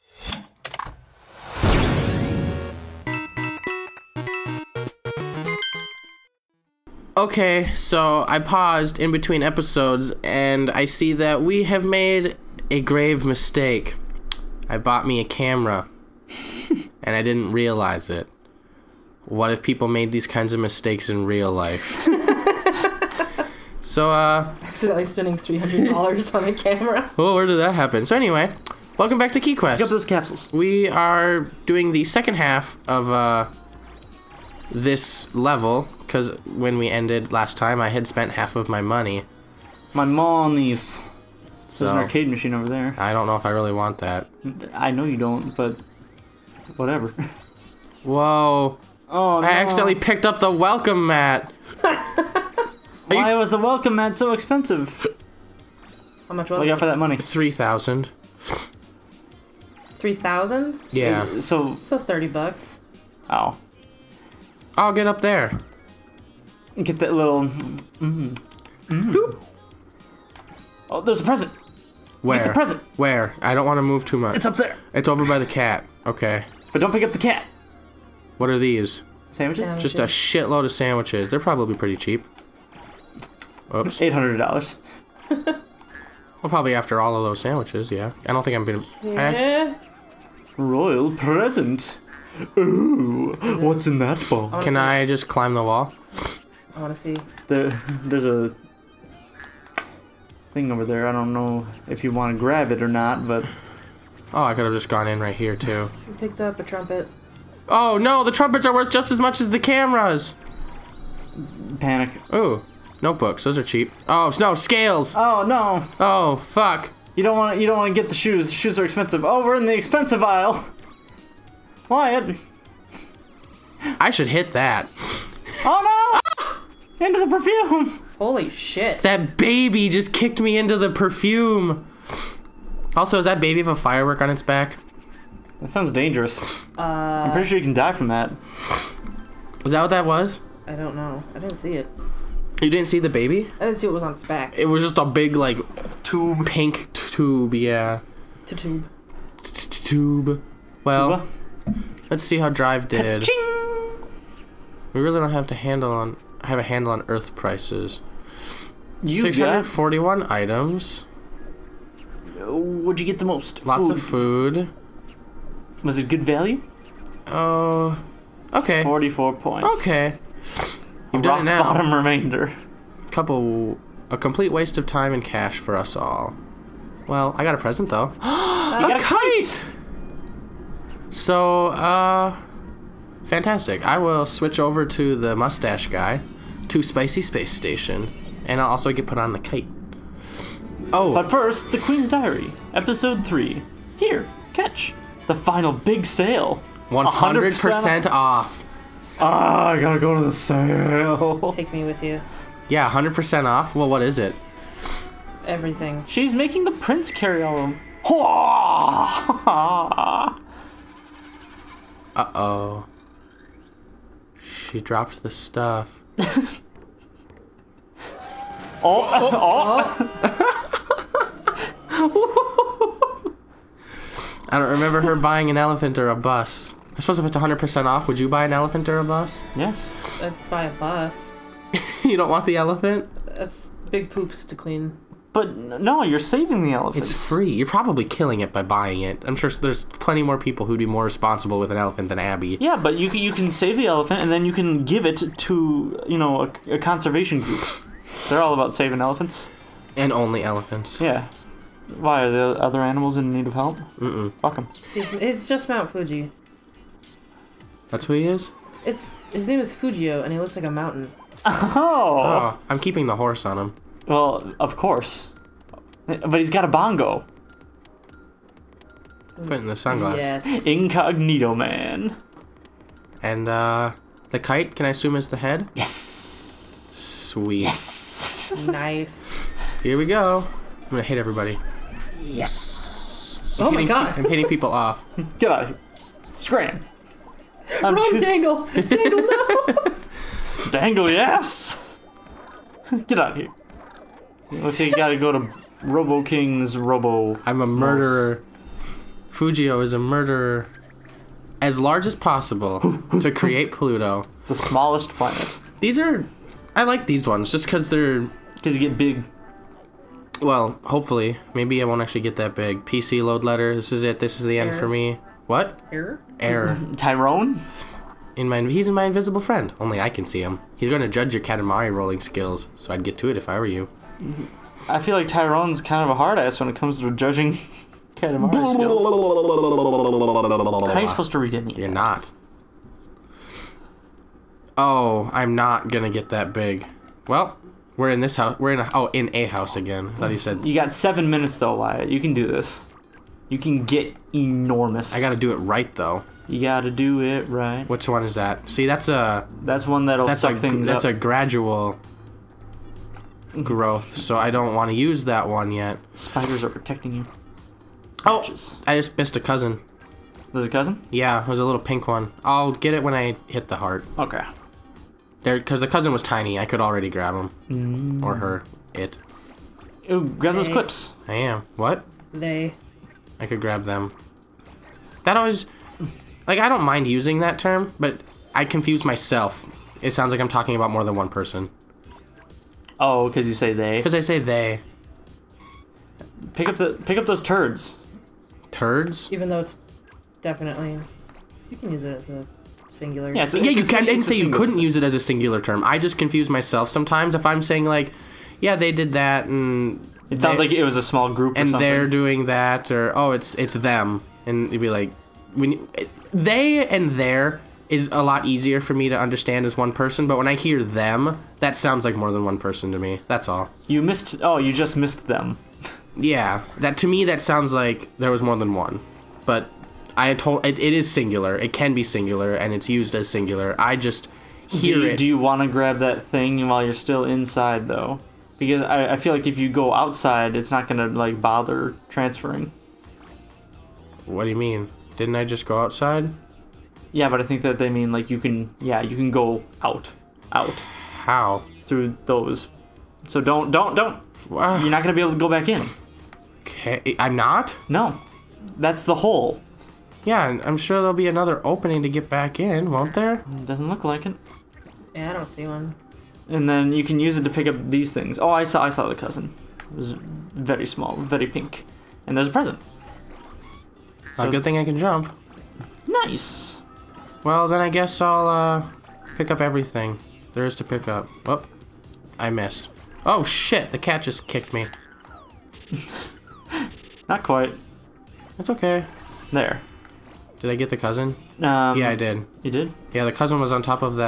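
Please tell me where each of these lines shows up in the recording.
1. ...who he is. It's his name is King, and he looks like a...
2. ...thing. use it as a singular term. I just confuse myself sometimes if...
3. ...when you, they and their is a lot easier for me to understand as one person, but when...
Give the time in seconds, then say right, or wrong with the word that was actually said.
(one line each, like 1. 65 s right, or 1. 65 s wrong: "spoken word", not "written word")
1. 258 s wrong: "Fujio", not "King"
2. 394 s right
3. 405 s right.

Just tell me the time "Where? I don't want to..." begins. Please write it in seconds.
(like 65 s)
72 s.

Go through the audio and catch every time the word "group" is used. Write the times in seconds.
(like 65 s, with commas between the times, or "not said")
247 s, 401 s.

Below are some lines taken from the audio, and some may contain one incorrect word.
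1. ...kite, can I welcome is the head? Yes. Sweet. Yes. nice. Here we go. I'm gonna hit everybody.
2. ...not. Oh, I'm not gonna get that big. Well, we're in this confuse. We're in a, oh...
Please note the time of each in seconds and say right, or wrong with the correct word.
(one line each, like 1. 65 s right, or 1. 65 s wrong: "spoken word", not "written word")
1. 274 s wrong: "assume", not "welcome"
2. 331 s wrong: "house", not "confuse".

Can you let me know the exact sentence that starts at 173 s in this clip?
Couple, a complete waste of time and cash for us all.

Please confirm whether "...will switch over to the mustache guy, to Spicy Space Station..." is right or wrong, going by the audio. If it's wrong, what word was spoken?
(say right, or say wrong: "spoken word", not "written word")
right.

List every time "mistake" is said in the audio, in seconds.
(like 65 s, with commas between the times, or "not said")
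13 s, 20 s.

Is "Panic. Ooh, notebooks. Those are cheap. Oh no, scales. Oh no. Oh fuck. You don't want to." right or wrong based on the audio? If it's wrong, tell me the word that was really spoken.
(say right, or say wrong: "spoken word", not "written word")
right.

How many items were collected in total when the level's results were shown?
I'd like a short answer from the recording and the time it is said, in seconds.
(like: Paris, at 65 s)
641, at 159 s.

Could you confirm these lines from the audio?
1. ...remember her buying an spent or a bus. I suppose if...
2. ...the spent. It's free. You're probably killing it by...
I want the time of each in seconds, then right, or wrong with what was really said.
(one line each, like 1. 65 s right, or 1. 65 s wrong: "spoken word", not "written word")
1. 224 s wrong: "elephant", not "spent"
2. 236 s wrong: "elephant", not "spent".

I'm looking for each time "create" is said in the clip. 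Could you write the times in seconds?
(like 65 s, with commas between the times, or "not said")
303 s.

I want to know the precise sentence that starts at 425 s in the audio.
Do you want to grab that thing while you're still inside though?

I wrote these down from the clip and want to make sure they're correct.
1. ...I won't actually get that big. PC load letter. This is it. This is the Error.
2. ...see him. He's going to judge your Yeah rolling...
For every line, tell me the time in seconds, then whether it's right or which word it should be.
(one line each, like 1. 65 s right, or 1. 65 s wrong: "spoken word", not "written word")
1. 311 s right
2. 320 s wrong: "Katamari", not "Yeah".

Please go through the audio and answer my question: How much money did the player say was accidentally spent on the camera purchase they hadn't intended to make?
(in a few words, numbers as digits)
$300.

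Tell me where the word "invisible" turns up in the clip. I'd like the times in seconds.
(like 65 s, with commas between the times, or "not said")
319 s.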